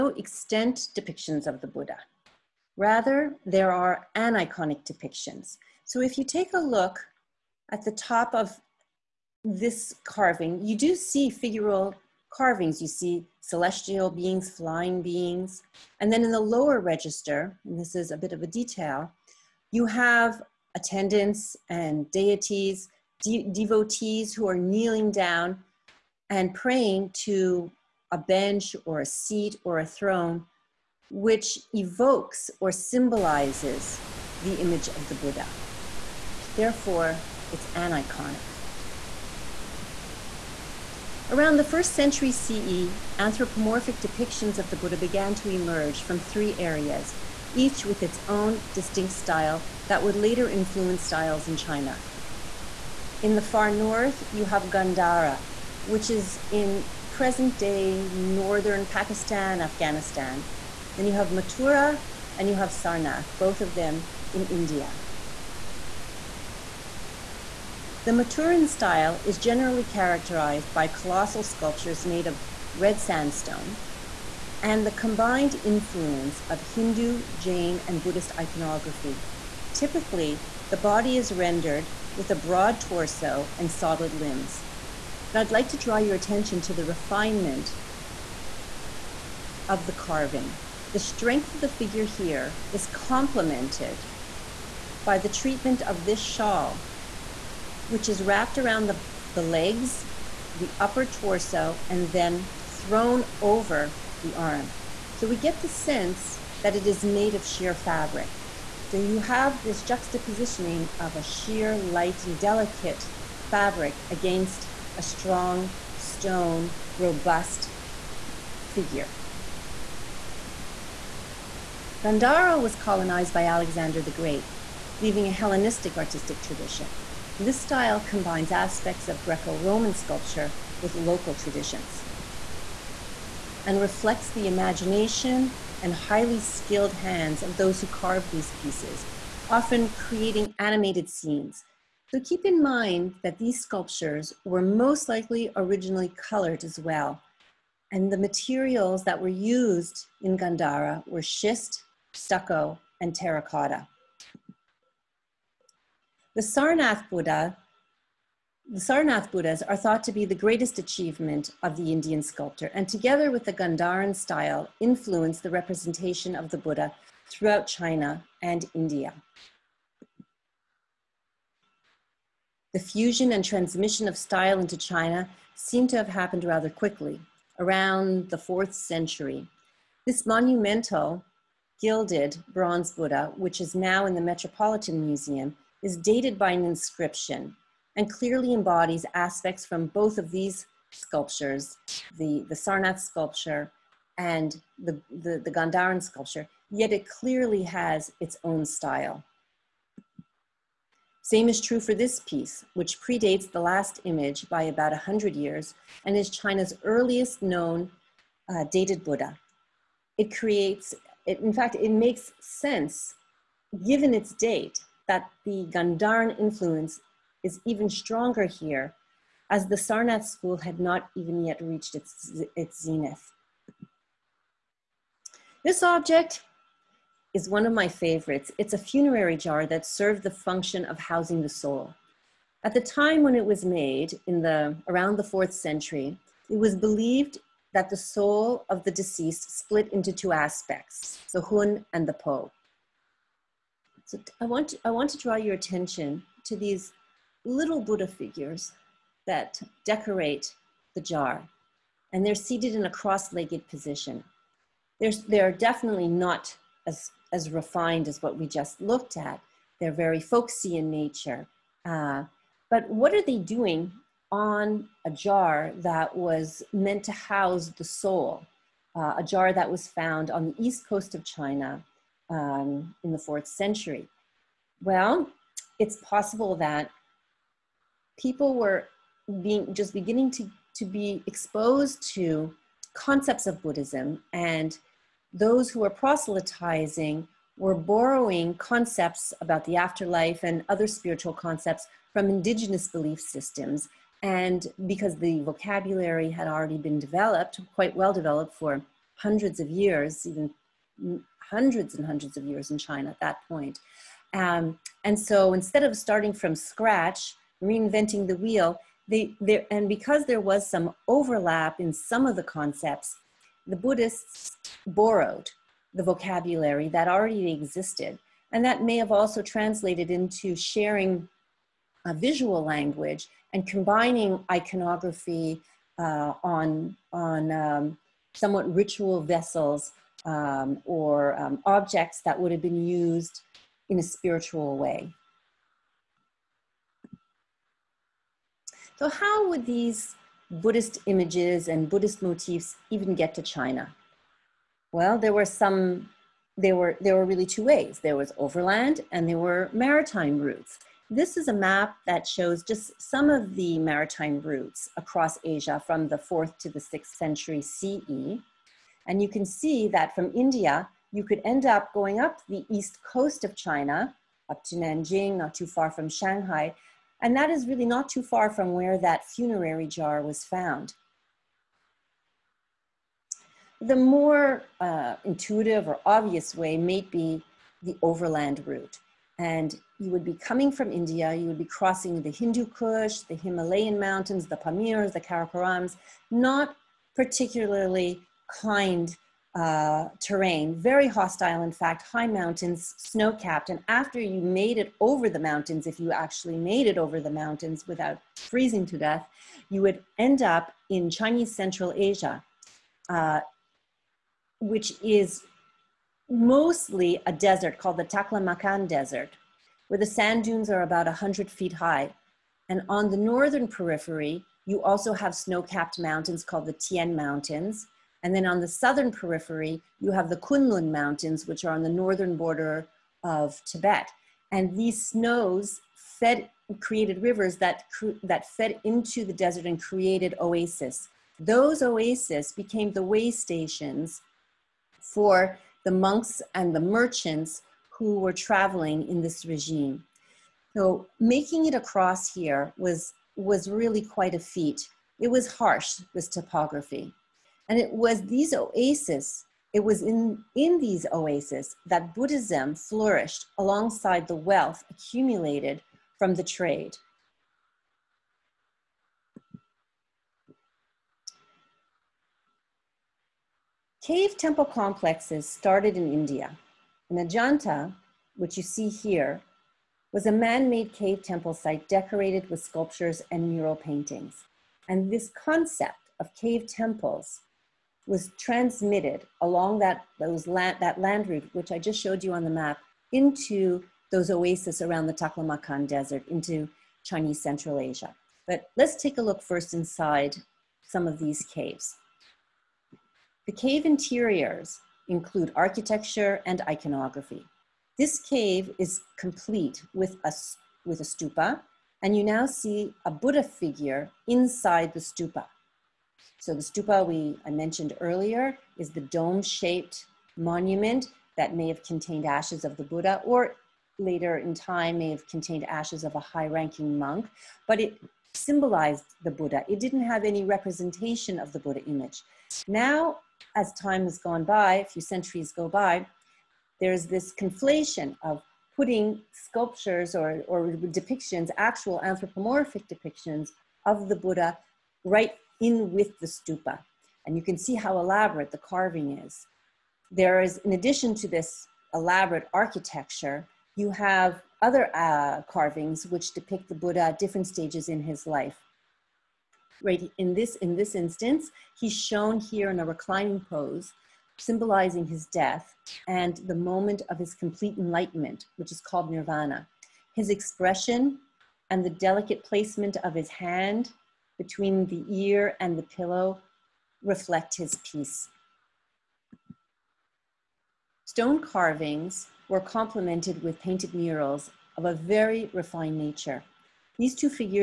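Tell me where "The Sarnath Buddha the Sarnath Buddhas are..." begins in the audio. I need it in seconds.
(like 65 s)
156 s.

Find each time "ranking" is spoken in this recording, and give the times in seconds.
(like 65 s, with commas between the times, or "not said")
516 s.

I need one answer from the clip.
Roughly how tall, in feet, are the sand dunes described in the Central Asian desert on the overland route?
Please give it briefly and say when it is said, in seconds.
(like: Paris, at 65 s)
100 feet, at 411 s.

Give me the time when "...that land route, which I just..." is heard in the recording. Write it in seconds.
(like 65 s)
480 s.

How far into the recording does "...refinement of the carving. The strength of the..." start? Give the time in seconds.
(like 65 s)
86 s.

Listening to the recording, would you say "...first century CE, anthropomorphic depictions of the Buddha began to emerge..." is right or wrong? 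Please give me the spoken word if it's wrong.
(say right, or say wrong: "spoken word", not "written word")
right.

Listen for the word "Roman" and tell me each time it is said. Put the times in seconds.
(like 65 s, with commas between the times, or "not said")
129 s.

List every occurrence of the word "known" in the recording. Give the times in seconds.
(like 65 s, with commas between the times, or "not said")
207 s.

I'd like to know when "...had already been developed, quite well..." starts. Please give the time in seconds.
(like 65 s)
296 s.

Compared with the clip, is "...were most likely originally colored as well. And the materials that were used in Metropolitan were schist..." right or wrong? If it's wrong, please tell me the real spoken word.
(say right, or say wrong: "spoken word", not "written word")
wrong: "Gandhara", not "Metropolitan".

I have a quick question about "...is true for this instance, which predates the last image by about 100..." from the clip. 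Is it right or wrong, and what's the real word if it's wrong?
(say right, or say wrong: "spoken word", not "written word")
wrong: "piece", not "instance".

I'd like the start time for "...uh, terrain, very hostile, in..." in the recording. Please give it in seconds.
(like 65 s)
389 s.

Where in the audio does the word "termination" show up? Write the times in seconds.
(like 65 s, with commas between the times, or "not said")
not said.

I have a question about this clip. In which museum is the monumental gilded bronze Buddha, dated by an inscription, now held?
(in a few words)
The Metropolitan Museum.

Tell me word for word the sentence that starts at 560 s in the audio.
His expression and the delicate placement of his hand between the ear and the pillow reflect his peace.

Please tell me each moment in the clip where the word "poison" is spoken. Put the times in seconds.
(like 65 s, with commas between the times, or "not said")
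not said.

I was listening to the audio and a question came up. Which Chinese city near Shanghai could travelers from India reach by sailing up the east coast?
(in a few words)
Nanjing.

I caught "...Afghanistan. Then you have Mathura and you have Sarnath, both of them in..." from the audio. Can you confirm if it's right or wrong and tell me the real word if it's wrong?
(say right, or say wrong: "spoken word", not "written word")
right.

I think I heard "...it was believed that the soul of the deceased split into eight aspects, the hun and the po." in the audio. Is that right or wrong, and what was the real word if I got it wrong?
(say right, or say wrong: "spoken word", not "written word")
wrong: "two", not "eight".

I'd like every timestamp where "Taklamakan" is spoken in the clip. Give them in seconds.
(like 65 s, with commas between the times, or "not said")
408 s, 485 s.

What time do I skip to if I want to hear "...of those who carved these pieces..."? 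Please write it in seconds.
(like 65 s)
137 s.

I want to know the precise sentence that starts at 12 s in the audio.
You see celestial beings, flying beings.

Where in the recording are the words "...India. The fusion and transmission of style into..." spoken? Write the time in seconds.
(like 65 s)
168 s.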